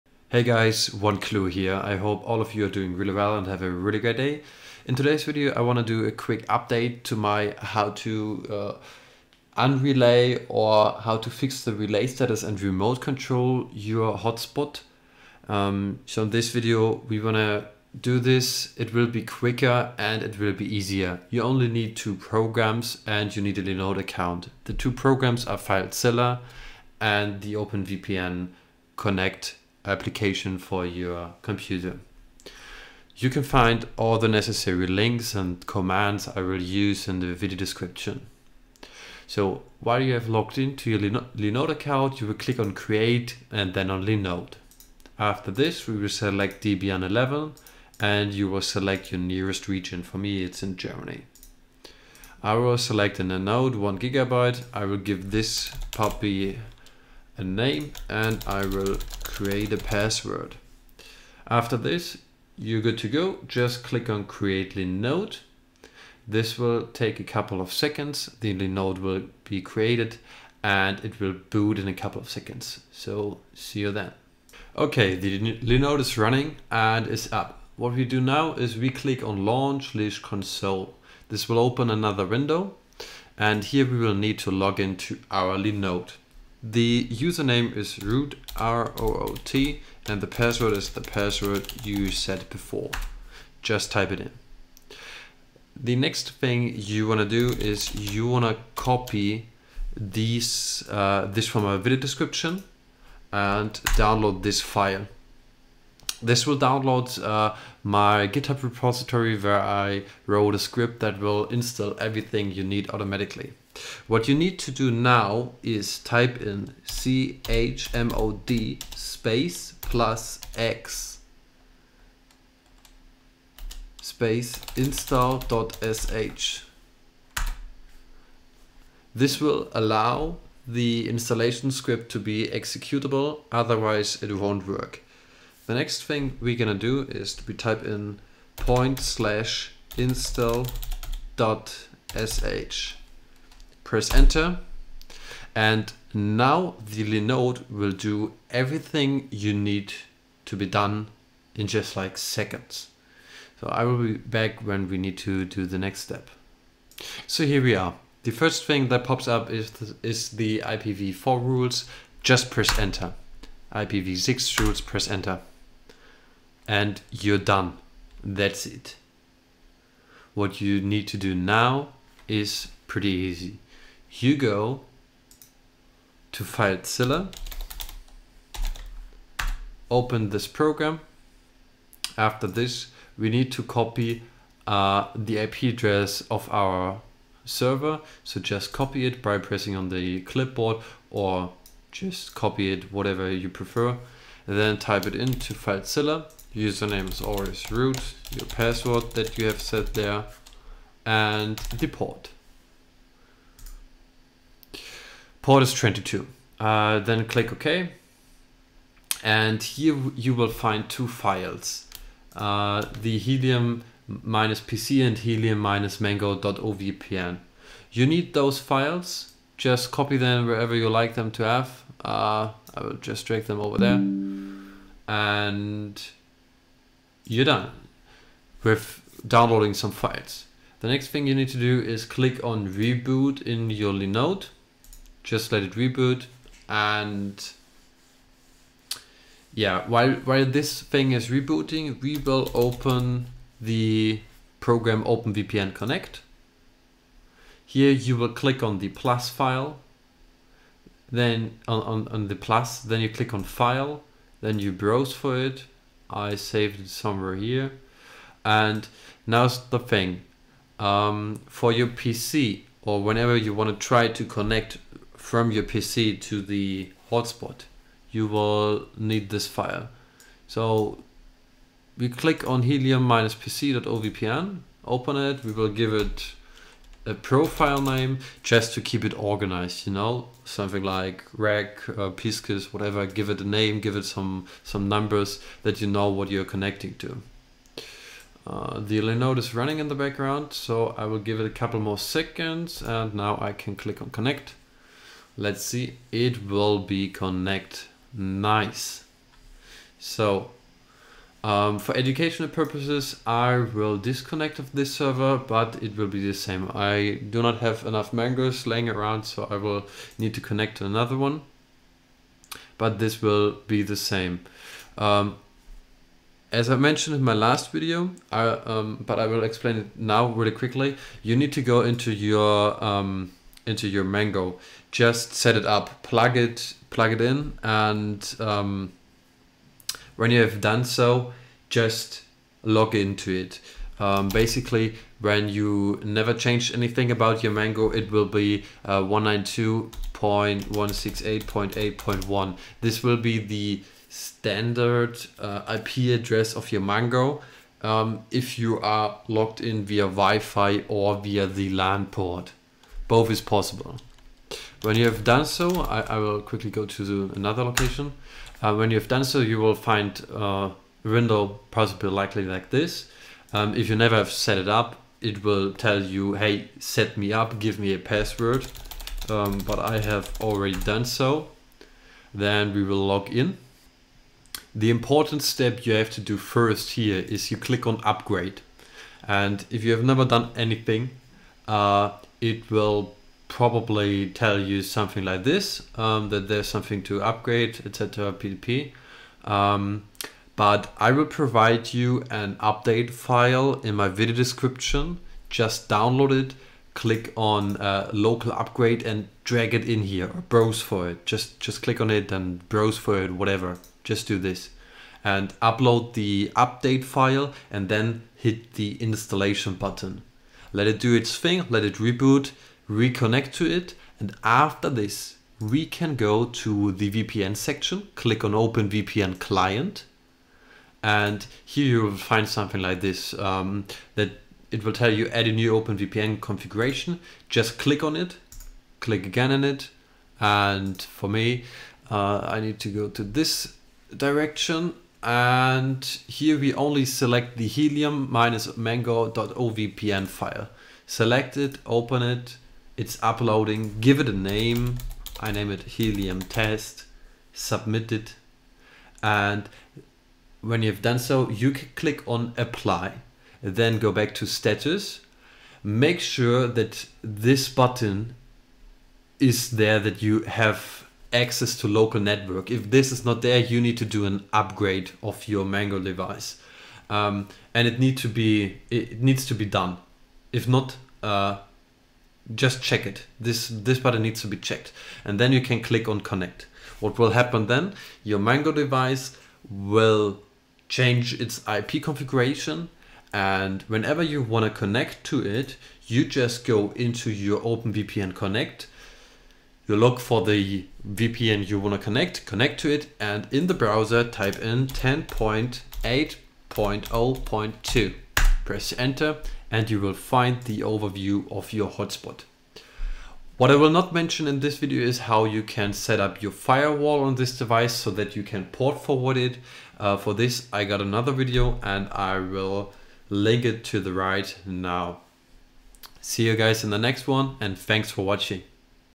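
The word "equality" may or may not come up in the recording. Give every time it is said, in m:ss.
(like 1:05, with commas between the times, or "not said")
not said.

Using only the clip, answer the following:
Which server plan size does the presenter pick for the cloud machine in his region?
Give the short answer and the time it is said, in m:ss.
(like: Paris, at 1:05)
Nanode 1 gigabyte, at 0:53.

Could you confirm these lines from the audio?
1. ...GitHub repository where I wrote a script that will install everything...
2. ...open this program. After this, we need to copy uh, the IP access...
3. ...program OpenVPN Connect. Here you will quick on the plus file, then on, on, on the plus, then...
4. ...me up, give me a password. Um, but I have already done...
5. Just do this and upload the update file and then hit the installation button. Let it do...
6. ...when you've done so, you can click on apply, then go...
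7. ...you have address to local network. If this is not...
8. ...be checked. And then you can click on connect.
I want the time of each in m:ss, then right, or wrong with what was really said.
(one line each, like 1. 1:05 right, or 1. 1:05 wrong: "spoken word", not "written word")
1. 1:48 right
2. 2:59 wrong: "address", not "access"
3. 4:04 wrong: "click", not "quick"
4. 6:07 right
5. 6:44 right
6. 7:30 right
7. 7:40 wrong: "access", not "address"
8. 7:54 right.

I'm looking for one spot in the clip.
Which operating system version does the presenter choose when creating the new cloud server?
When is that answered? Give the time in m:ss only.
0:46.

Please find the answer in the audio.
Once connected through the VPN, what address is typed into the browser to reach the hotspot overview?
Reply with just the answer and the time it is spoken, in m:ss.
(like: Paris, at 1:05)
10.8.0.2, at 8:14.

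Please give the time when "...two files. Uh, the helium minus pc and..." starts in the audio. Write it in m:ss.
3:30.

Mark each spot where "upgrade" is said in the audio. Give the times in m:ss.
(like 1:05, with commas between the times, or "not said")
6:18, 6:27, 6:38, 7:44.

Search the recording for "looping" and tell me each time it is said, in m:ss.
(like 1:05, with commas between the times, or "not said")
not said.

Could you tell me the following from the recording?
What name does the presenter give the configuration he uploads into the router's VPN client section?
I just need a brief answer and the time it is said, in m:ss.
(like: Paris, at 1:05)
helium test, at 7:25.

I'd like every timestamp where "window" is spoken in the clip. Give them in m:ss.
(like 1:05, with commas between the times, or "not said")
1:22, 6:01.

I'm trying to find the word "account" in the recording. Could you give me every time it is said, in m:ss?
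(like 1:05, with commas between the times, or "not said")
0:23, 0:41.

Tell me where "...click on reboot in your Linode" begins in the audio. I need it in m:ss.
3:52.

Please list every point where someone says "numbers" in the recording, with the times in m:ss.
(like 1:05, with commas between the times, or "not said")
4:44.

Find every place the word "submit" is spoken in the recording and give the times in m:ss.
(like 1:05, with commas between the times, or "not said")
7:27.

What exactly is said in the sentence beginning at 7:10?
And for me, uh, I need to go to this direction and here we only select the helium minus mango.ovpn file.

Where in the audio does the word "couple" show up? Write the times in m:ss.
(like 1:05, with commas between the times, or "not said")
1:07, 1:11, 4:51.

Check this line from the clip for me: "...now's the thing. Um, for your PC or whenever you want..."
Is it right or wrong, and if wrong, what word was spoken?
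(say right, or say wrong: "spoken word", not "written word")
right.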